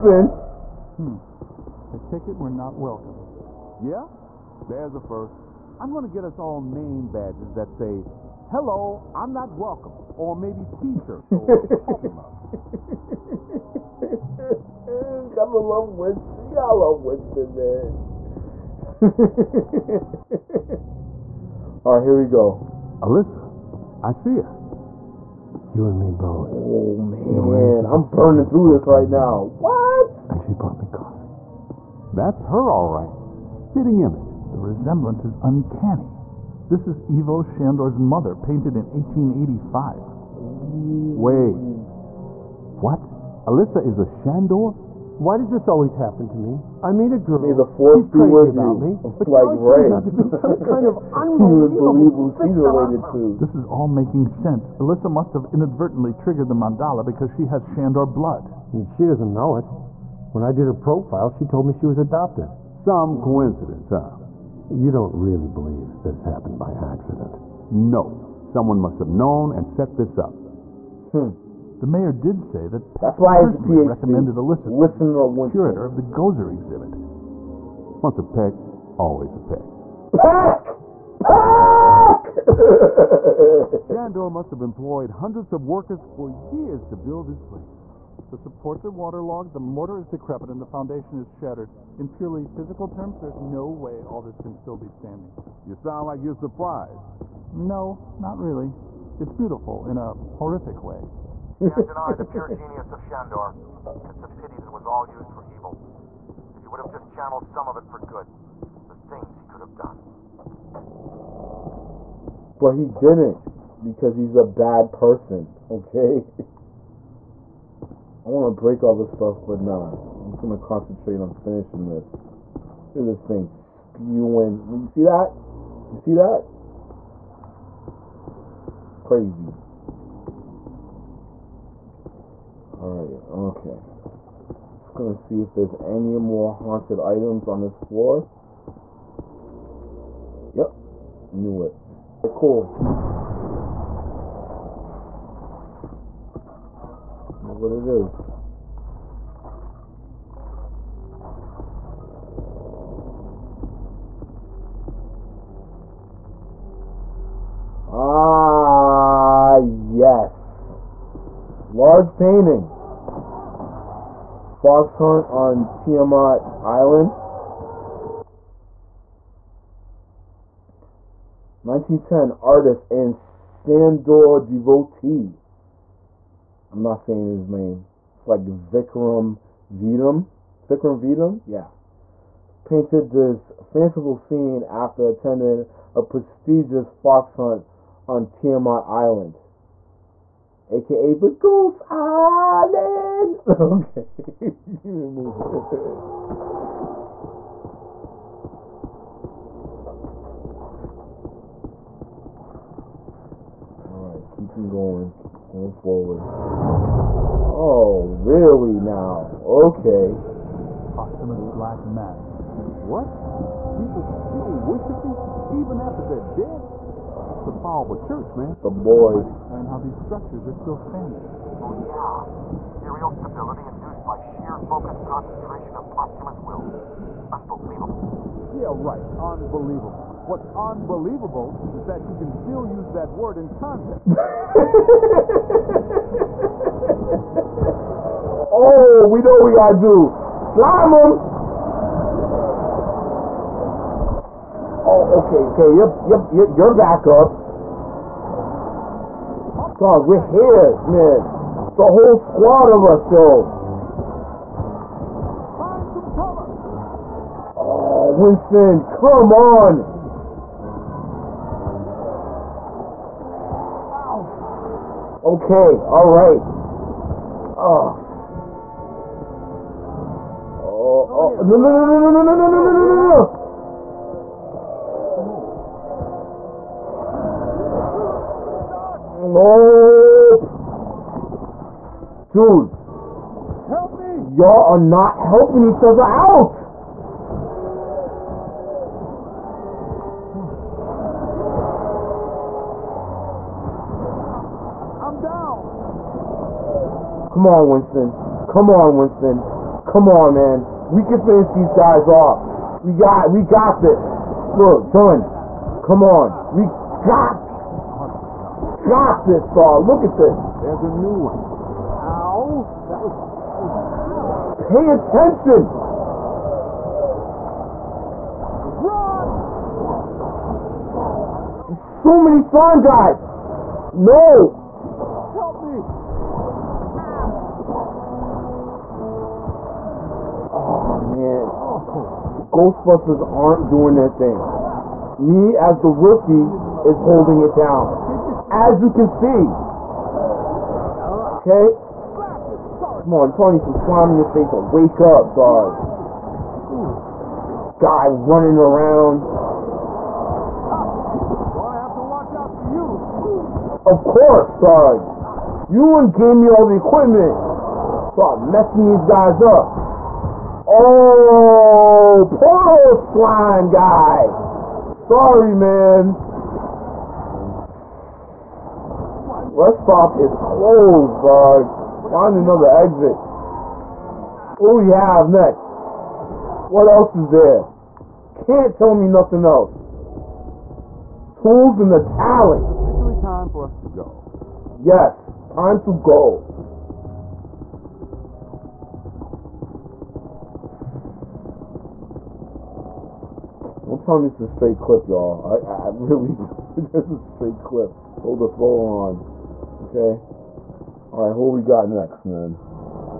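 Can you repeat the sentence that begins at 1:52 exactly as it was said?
But he didn't, because he's a bad person, okay?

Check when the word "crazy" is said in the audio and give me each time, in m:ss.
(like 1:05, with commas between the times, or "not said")
0:48, 2:09.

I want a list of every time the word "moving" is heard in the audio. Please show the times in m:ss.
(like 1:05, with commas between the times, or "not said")
3:15.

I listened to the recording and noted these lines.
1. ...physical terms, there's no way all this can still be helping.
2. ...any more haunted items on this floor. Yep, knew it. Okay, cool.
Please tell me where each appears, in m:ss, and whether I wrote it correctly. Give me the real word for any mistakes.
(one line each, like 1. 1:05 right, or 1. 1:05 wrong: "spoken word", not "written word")
1. 1:32 wrong: "standing", not "helping"
2. 2:15 right.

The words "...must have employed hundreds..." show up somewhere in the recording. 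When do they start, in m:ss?
1:24.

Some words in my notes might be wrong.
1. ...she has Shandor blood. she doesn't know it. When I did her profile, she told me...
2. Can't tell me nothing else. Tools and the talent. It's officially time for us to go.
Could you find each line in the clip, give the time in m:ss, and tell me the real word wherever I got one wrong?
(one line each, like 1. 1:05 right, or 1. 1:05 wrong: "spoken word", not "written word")
1. 0:57 right
2. 6:18 right.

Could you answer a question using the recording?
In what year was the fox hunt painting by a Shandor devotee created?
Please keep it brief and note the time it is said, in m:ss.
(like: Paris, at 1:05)
1910, at 2:51.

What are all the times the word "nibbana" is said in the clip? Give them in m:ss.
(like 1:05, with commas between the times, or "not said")
not said.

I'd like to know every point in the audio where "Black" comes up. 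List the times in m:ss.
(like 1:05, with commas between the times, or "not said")
3:31.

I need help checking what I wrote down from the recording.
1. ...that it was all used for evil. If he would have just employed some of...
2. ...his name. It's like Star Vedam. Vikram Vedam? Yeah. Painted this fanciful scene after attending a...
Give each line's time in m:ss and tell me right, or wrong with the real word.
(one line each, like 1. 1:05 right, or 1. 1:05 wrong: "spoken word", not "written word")
1. 1:44 wrong: "channeled", not "employed"
2. 2:57 wrong: "Vikram", not "Star".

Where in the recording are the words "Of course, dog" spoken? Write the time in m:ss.
5:53.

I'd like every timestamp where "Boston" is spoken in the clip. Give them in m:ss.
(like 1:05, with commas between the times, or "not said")
not said.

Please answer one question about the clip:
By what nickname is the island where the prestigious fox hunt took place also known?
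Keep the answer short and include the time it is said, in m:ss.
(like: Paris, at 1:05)
Ghost Island, at 3:11.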